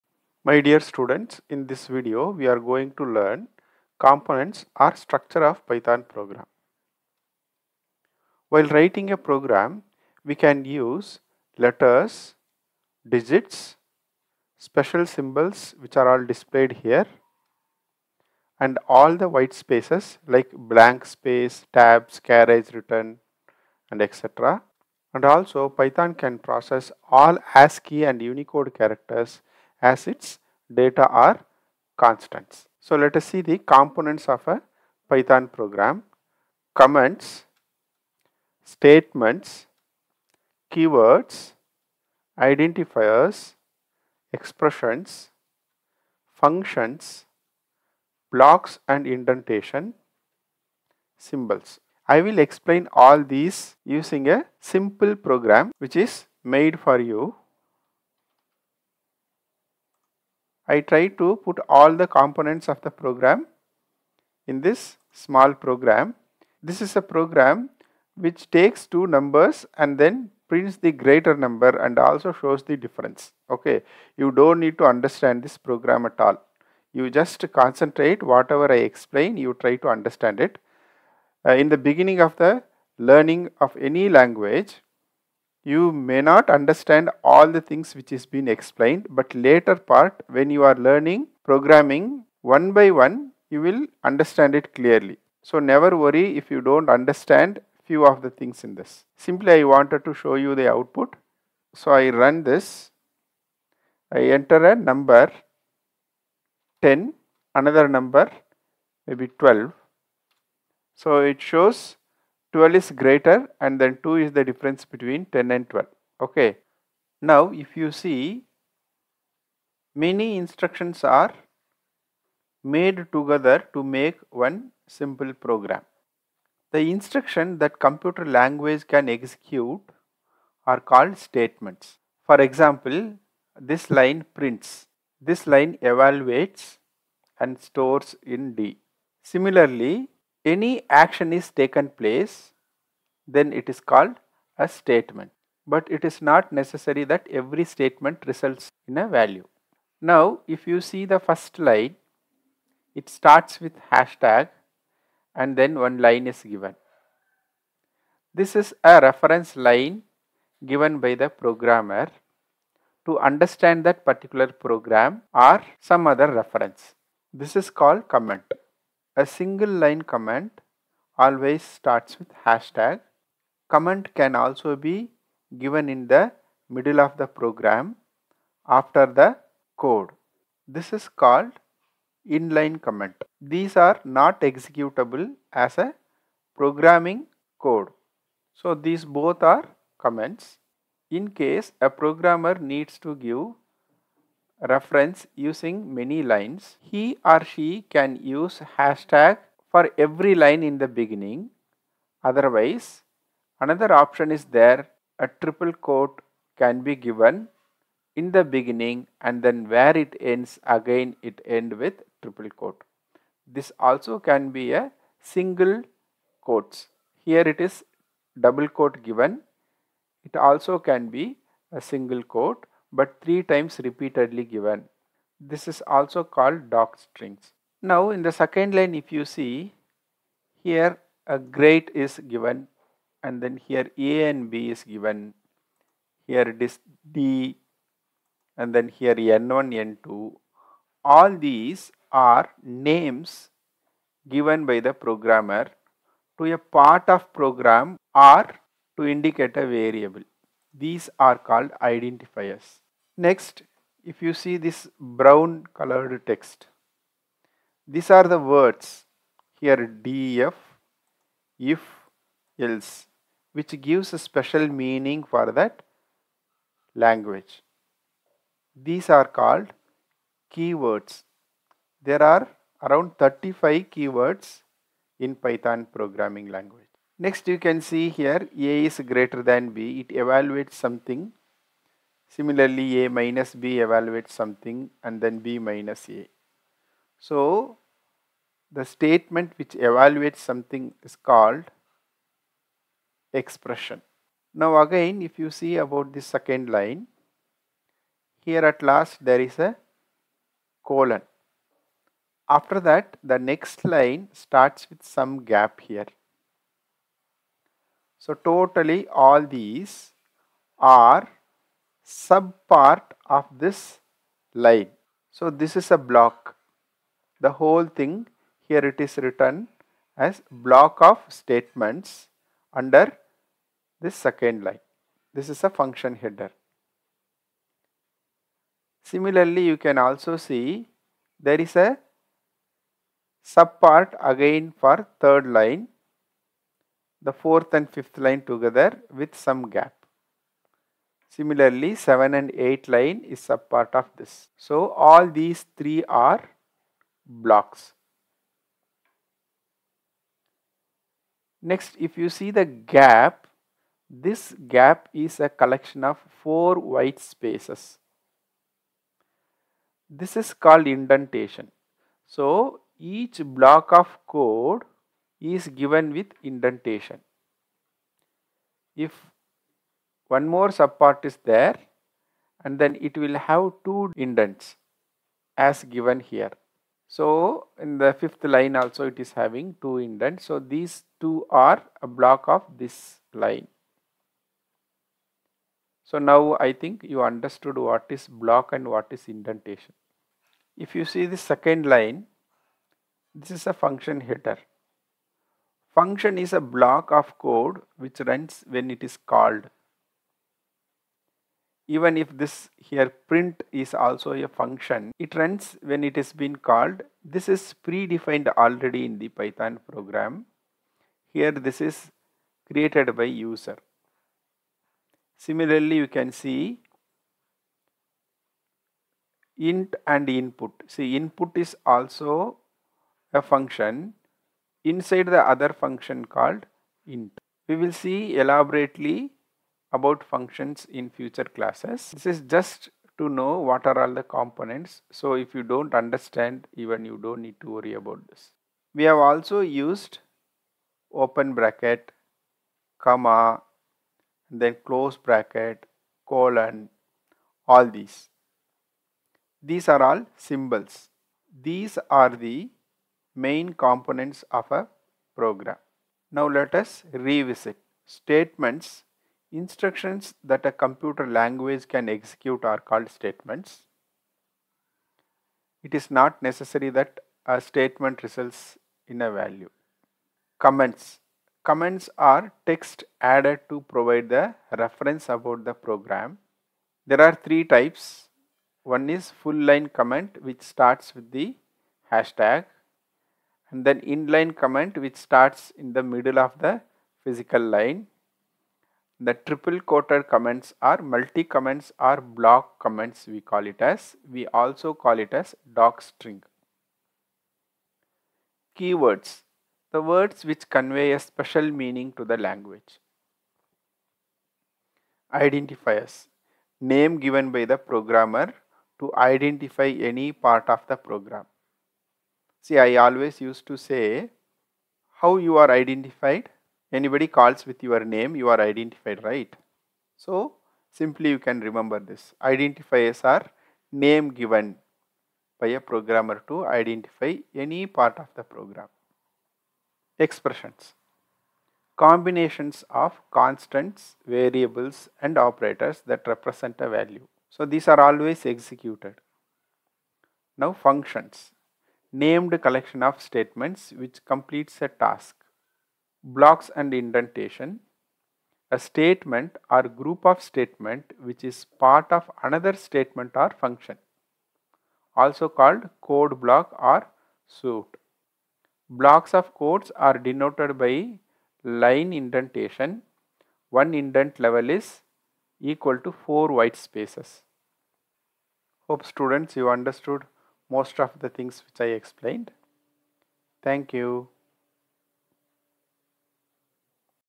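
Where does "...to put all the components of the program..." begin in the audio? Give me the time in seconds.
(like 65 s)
61 s.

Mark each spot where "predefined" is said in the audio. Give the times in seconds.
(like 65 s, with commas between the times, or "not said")
407 s.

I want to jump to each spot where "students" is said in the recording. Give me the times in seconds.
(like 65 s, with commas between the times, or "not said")
0 s, 569 s.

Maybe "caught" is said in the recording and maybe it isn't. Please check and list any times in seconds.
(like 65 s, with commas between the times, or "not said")
not said.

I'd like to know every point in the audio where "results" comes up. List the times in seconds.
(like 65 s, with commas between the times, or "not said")
148 s, 468 s.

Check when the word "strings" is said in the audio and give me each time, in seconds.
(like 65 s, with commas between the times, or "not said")
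226 s, 496 s.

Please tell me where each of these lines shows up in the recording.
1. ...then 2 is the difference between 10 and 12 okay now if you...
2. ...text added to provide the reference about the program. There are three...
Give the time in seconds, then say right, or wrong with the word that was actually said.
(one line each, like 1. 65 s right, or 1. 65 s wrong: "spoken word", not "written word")
1. 113 s right
2. 472 s right.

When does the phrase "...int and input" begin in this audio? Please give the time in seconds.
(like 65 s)
419 s.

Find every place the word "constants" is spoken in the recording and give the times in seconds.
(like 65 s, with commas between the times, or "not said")
31 s, 533 s.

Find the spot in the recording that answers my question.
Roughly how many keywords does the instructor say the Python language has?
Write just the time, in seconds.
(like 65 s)
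273 s.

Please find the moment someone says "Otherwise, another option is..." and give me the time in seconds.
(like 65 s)
202 s.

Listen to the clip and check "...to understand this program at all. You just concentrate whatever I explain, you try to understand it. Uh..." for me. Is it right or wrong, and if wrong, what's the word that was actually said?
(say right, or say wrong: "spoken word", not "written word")
right.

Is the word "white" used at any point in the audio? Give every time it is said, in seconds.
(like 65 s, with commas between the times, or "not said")
19 s, 356 s, 566 s.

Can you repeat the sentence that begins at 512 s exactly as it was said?
See, I always used to say how you are identified.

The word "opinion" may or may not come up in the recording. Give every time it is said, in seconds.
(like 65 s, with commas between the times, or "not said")
not said.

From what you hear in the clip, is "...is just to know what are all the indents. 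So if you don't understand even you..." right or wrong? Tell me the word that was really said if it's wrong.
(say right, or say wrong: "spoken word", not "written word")
wrong: "components", not "indents".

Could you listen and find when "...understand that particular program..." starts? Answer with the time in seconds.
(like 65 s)
163 s.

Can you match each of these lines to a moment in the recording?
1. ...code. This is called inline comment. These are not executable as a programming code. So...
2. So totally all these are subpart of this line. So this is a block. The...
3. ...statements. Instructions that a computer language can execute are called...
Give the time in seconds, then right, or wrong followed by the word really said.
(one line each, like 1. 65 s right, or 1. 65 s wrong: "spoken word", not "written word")
1. 179 s right
2. 308 s right
3. 458 s right.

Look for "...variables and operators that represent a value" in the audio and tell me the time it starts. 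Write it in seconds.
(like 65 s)
534 s.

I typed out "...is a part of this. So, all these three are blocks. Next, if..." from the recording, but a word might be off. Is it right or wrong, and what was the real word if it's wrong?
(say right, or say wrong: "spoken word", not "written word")
right.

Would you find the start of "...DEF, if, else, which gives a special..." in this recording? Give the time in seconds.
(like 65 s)
259 s.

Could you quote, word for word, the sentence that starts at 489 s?
The triple quoted comments are multi comments or block comments we call it as.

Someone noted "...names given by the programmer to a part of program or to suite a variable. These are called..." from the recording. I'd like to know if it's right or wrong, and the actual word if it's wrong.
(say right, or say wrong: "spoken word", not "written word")
wrong: "indicate", not "suite".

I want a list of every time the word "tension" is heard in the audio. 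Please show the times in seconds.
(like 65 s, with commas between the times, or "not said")
not said.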